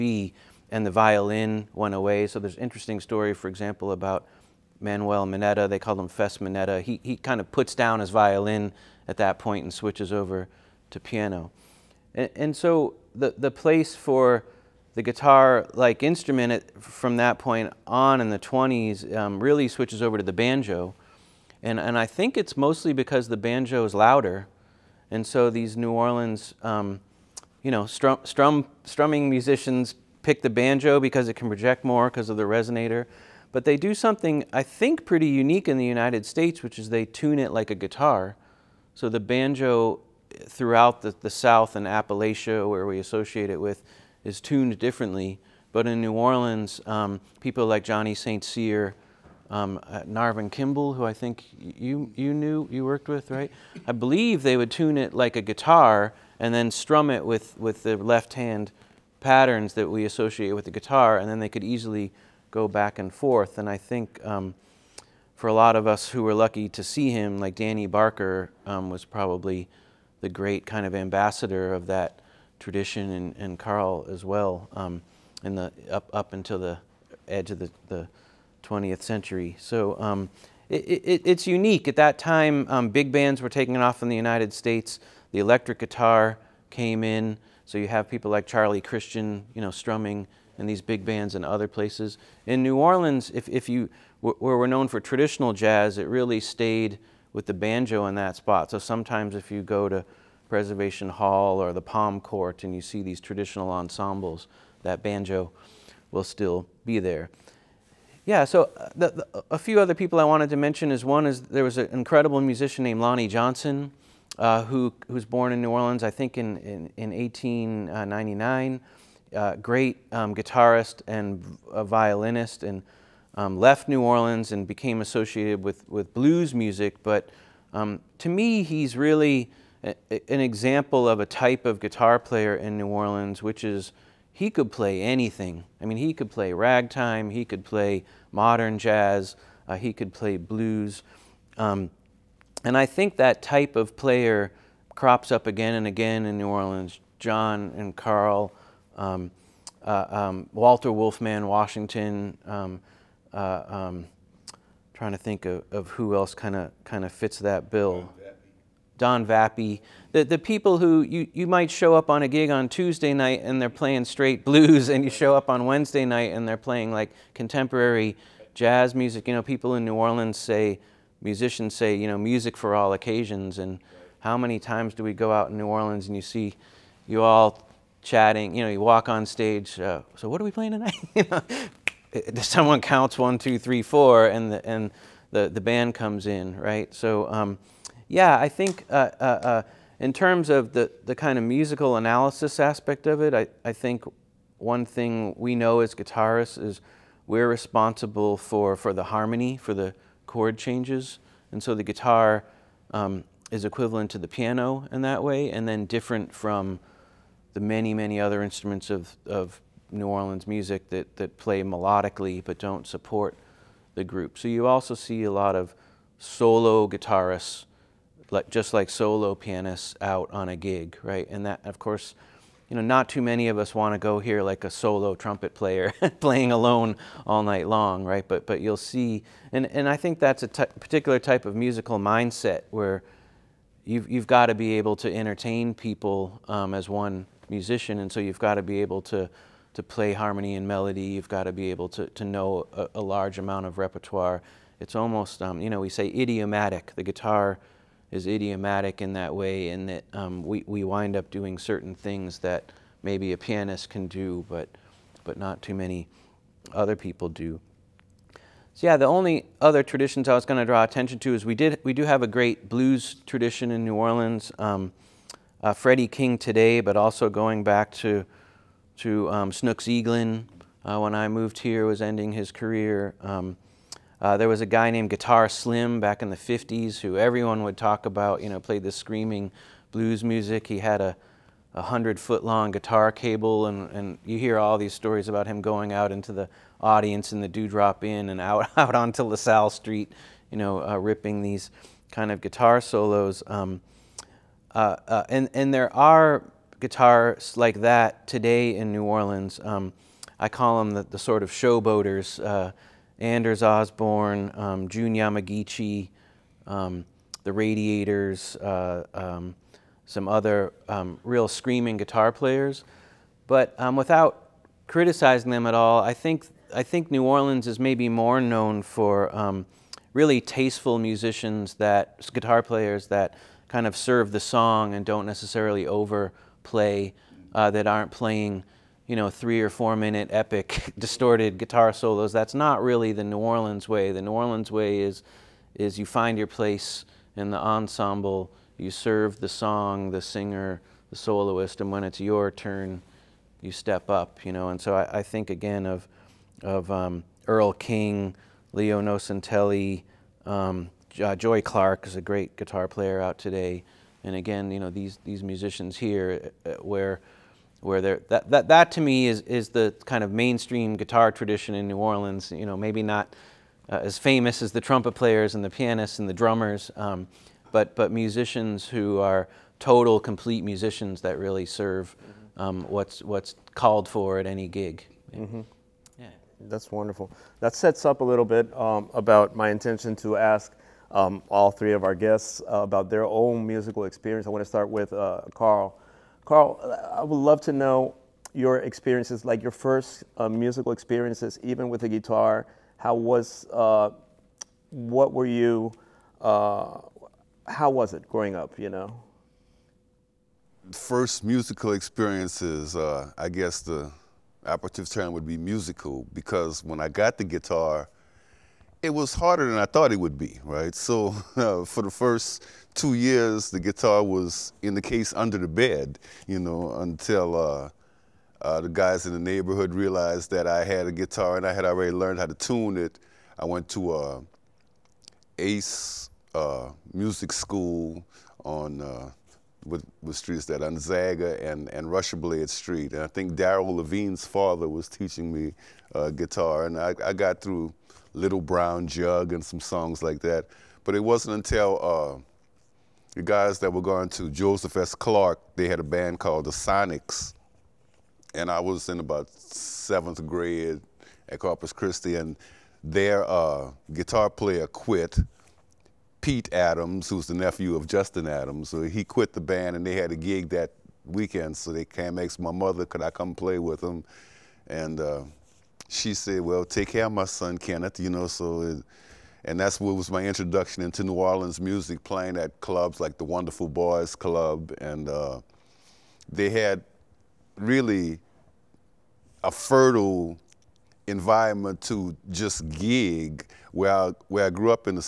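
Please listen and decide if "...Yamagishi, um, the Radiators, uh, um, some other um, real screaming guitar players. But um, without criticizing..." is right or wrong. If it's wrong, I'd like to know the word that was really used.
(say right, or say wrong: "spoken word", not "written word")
right.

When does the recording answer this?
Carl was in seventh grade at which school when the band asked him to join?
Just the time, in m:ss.
7:31.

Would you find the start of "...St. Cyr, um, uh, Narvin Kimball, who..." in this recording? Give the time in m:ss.
0:48.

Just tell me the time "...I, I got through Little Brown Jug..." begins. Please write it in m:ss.
7:16.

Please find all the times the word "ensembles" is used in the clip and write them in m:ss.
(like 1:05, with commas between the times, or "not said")
1:43, 5:37.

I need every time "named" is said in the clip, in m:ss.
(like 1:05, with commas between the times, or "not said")
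1:52, 4:34.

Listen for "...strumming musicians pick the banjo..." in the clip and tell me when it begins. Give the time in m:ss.
0:28.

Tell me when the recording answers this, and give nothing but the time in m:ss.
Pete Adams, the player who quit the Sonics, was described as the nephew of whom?
7:38.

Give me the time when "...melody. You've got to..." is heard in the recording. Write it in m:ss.
4:00.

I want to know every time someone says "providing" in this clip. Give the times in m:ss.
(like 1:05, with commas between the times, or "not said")
not said.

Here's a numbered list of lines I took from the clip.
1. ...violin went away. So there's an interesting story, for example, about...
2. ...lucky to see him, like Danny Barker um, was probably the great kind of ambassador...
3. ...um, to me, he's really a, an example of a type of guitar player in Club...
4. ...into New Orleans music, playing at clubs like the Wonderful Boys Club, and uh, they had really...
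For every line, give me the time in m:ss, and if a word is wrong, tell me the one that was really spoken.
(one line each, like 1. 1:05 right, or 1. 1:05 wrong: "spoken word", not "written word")
1. 0:00 right
2. 1:06 right
3. 2:07 wrong: "New", not "Club"
4. 7:51 right.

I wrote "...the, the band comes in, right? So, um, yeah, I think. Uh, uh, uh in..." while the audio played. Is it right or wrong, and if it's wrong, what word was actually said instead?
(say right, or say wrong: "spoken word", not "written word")
right.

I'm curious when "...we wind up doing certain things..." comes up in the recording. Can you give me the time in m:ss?
4:10.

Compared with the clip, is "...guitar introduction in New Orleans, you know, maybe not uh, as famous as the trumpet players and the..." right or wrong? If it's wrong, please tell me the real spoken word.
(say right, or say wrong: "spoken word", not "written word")
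wrong: "tradition", not "introduction".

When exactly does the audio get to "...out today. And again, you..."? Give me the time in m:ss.
5:53.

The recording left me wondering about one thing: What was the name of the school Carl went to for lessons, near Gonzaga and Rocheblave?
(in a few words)
Ace.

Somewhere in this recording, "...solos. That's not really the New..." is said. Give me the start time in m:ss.
5:31.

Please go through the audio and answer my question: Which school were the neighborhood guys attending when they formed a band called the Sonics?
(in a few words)
Joseph S. Clark.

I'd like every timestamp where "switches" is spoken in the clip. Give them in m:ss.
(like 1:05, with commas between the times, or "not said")
0:09, 0:19.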